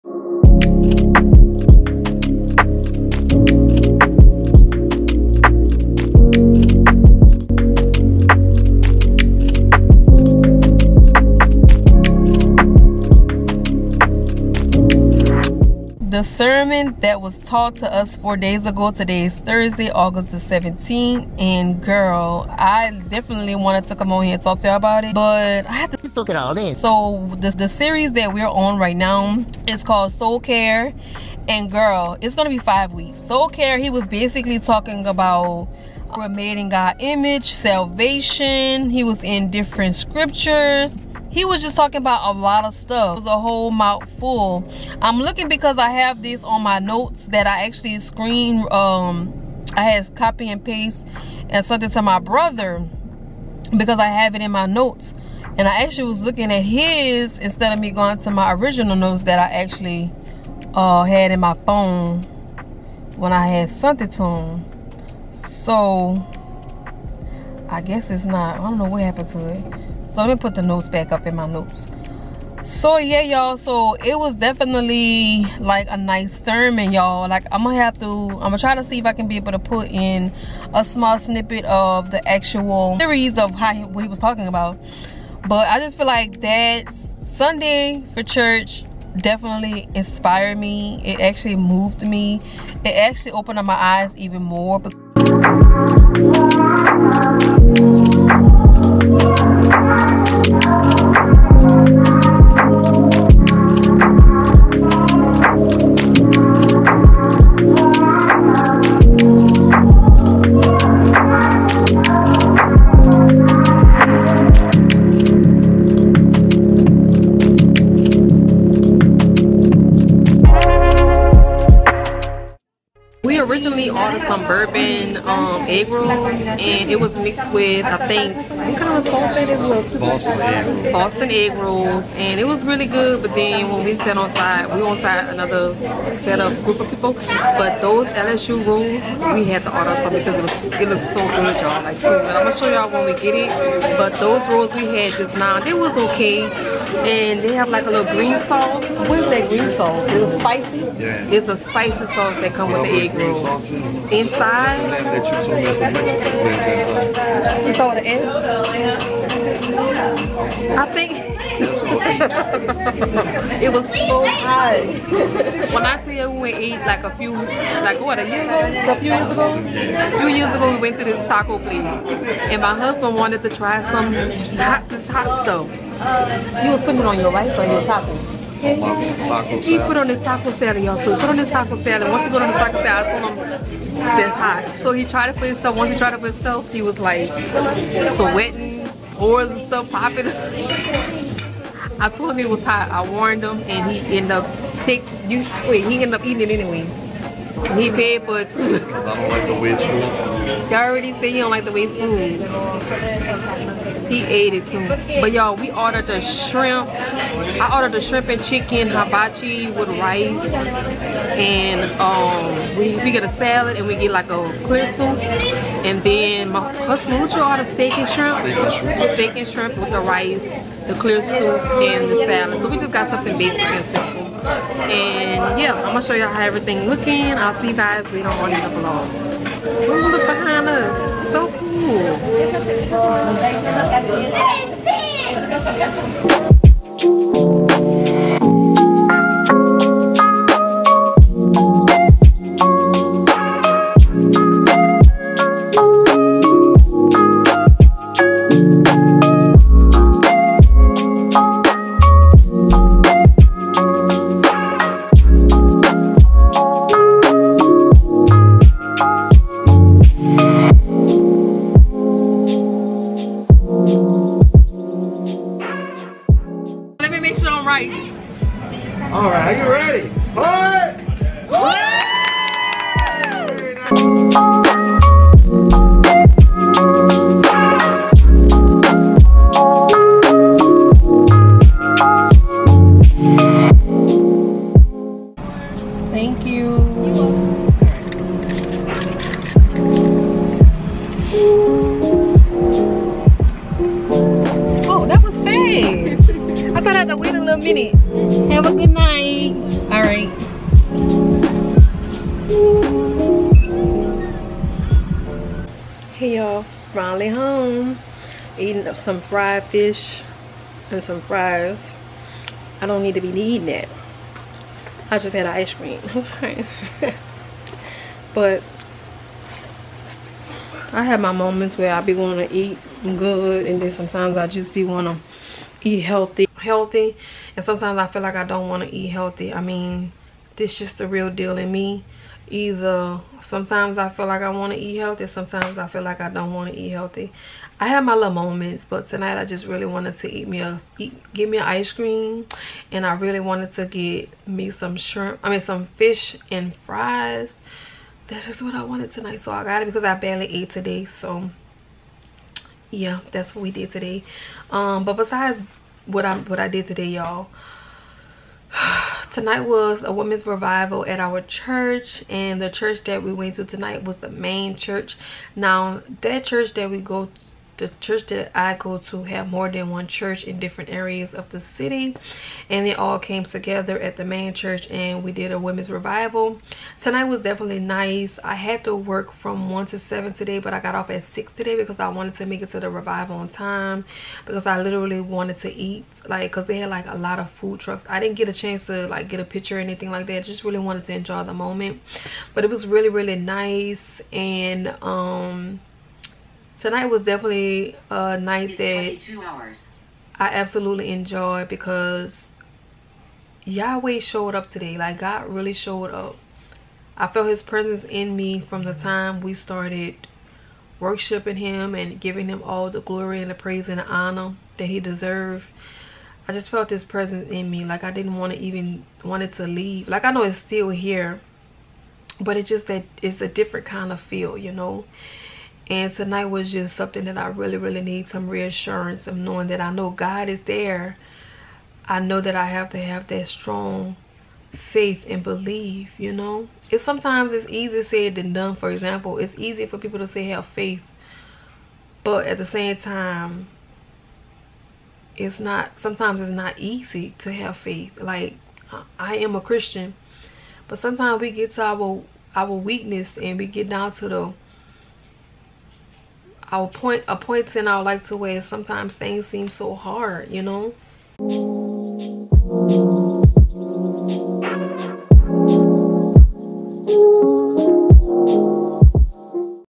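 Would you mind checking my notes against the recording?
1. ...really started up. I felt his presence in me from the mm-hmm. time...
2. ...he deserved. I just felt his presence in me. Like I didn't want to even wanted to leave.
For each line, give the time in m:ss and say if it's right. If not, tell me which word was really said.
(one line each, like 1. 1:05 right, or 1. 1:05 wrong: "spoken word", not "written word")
1. 6:45 wrong: "showed", not "started"
2. 6:54 right.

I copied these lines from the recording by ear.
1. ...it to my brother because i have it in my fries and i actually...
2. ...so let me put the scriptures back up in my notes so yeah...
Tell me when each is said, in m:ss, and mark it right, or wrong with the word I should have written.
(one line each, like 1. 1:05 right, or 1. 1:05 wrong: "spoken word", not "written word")
1. 0:51 wrong: "notes", not "fries"
2. 1:10 wrong: "notes", not "scriptures".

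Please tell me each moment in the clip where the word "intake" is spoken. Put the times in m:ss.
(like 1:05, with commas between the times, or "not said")
not said.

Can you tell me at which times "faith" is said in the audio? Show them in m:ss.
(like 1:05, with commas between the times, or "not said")
7:14, 7:20, 7:27.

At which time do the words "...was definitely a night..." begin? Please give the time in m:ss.
6:37.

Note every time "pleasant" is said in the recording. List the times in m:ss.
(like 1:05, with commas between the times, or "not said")
not said.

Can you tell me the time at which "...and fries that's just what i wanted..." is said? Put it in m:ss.
5:46.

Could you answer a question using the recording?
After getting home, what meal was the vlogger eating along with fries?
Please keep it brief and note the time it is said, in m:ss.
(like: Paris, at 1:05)
Fried fish, at 5:09.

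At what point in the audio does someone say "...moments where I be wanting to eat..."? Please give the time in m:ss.
5:21.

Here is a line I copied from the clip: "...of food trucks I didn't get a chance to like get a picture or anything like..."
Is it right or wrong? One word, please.
right.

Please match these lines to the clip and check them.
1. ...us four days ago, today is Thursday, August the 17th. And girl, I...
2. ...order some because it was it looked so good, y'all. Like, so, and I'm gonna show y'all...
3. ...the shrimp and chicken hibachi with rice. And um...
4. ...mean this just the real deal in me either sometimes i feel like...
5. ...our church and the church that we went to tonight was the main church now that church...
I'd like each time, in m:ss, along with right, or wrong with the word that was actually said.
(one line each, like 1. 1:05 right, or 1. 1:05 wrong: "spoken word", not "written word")
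1. 0:17 right
2. 2:19 right
3. 3:27 right
4. 5:29 right
5. 6:01 right.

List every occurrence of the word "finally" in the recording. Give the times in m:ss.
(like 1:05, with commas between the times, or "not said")
5:06.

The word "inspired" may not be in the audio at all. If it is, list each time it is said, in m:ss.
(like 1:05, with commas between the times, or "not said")
1:29.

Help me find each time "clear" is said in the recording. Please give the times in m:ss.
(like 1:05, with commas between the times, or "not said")
3:34, 3:40.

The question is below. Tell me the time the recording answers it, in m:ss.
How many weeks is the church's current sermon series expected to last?
0:32.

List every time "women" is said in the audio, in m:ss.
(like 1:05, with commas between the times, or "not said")
6:00, 6:15.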